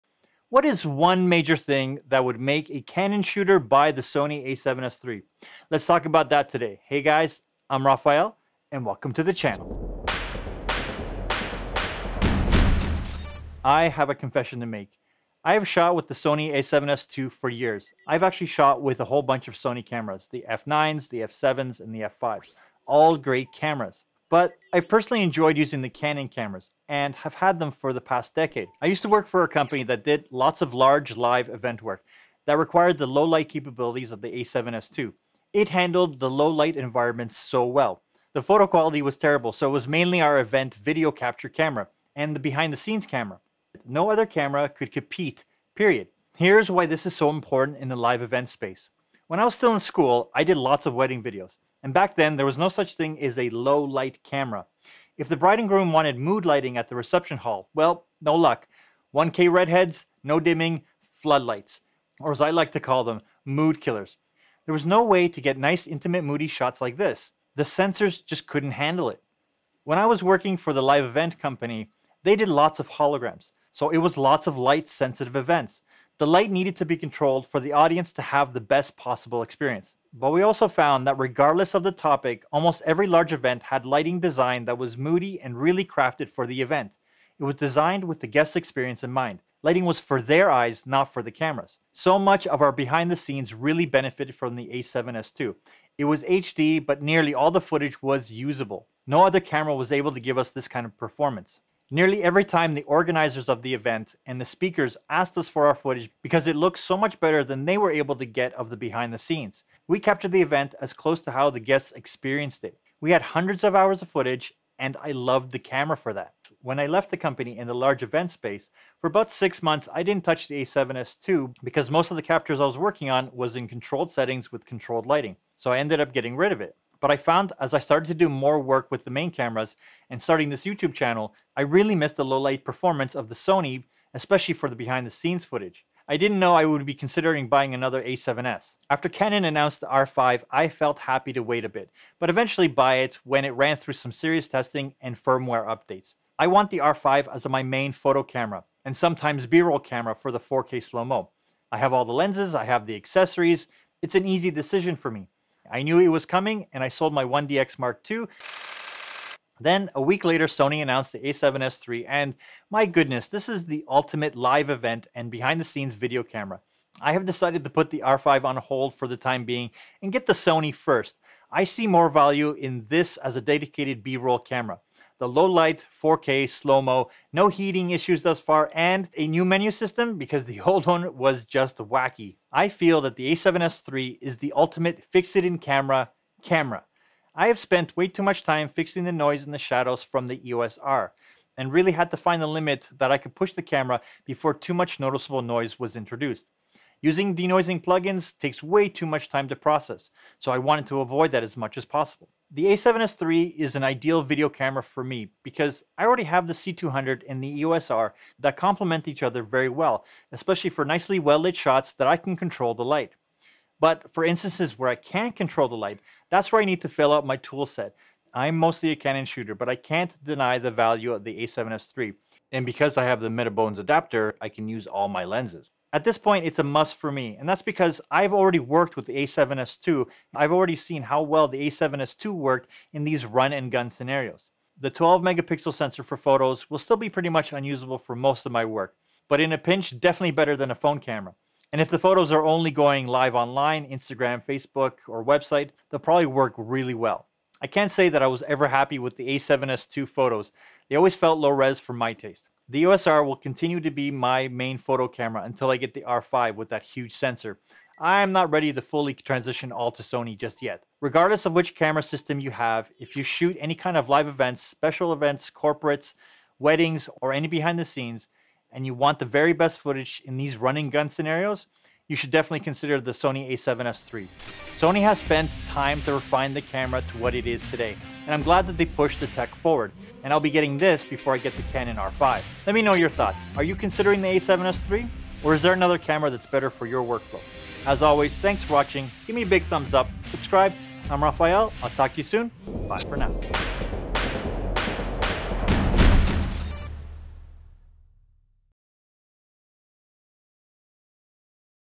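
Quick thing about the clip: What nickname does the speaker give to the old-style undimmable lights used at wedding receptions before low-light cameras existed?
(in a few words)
Mood killers.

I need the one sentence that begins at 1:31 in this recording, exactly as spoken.
So much of our behind the scenes really benefited from the A7S2.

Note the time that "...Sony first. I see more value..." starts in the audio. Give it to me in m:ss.
2:50.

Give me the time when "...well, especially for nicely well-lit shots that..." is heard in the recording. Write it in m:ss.
3:29.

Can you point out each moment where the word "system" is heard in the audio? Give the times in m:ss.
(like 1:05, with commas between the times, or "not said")
2:59, 4:22.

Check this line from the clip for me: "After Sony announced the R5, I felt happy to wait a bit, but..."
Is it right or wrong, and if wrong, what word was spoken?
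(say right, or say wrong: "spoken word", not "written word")
wrong: "Canon", not "Sony".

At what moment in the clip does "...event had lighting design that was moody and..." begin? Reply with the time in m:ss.
1:23.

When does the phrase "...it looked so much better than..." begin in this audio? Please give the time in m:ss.
1:46.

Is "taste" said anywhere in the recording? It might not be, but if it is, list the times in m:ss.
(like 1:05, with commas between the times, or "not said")
4:12.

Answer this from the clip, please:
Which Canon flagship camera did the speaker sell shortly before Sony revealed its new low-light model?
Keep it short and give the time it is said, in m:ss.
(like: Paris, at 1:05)
1DX Mark II, at 2:37.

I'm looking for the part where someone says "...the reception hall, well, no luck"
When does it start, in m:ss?
0:56.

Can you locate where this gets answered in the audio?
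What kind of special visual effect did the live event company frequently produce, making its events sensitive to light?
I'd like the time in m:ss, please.
1:12.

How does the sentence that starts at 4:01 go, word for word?
And if the photos are only going live online, Instagram, Facebook, or website, they'll probably work really well.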